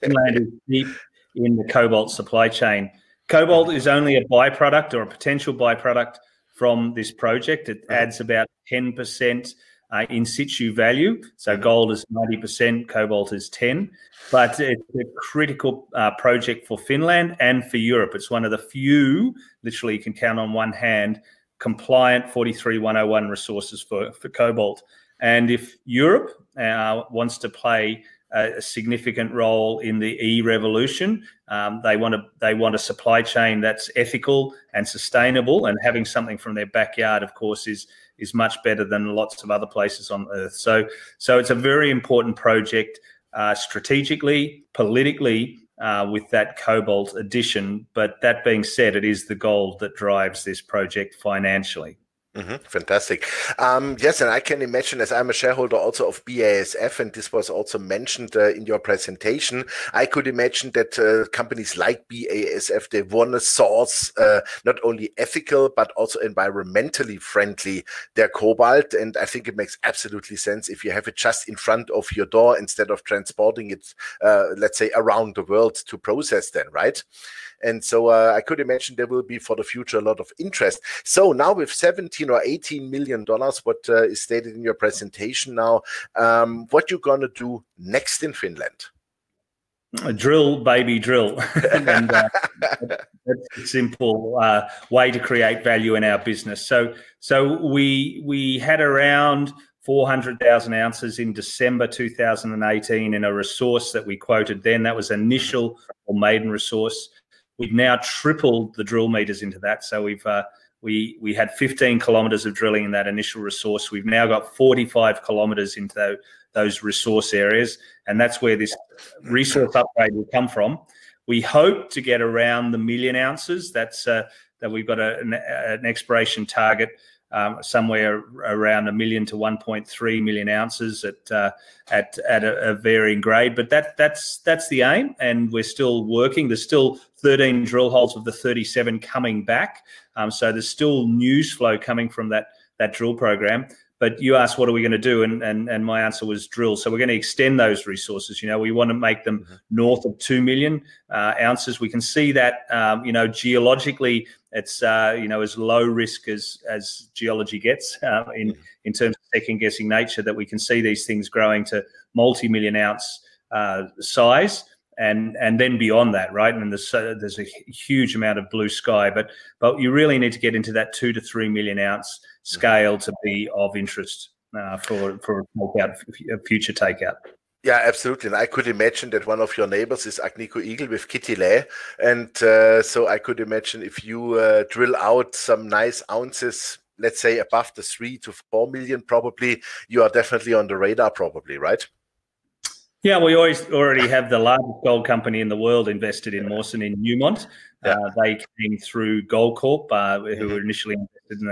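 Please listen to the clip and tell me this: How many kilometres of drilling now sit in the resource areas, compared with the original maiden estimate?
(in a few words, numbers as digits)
45 kilometres.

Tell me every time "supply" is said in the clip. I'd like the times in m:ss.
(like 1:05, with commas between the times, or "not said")
0:02, 0:32.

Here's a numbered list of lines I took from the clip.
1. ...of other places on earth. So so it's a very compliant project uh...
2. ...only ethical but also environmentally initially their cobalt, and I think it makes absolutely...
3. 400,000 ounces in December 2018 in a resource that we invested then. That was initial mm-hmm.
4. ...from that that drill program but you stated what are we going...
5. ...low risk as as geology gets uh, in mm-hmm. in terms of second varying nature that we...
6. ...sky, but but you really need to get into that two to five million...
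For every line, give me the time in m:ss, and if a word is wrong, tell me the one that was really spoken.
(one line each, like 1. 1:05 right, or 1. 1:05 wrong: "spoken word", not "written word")
1. 0:39 wrong: "important", not "compliant"
2. 1:04 wrong: "friendly", not "initially"
3. 1:39 wrong: "quoted", not "invested"
4. 2:22 wrong: "asked", not "stated"
5. 2:35 wrong: "guessing", not "varying"
6. 2:48 wrong: "three", not "five".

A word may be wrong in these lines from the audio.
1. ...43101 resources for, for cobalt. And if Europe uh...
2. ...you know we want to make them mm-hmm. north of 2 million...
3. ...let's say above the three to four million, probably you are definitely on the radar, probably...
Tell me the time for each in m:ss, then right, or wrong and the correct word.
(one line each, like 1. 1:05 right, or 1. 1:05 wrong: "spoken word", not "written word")
1. 0:22 right
2. 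2:28 right
3. 3:06 right.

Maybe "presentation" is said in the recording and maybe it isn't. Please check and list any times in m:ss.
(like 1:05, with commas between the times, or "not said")
0:58, 1:24.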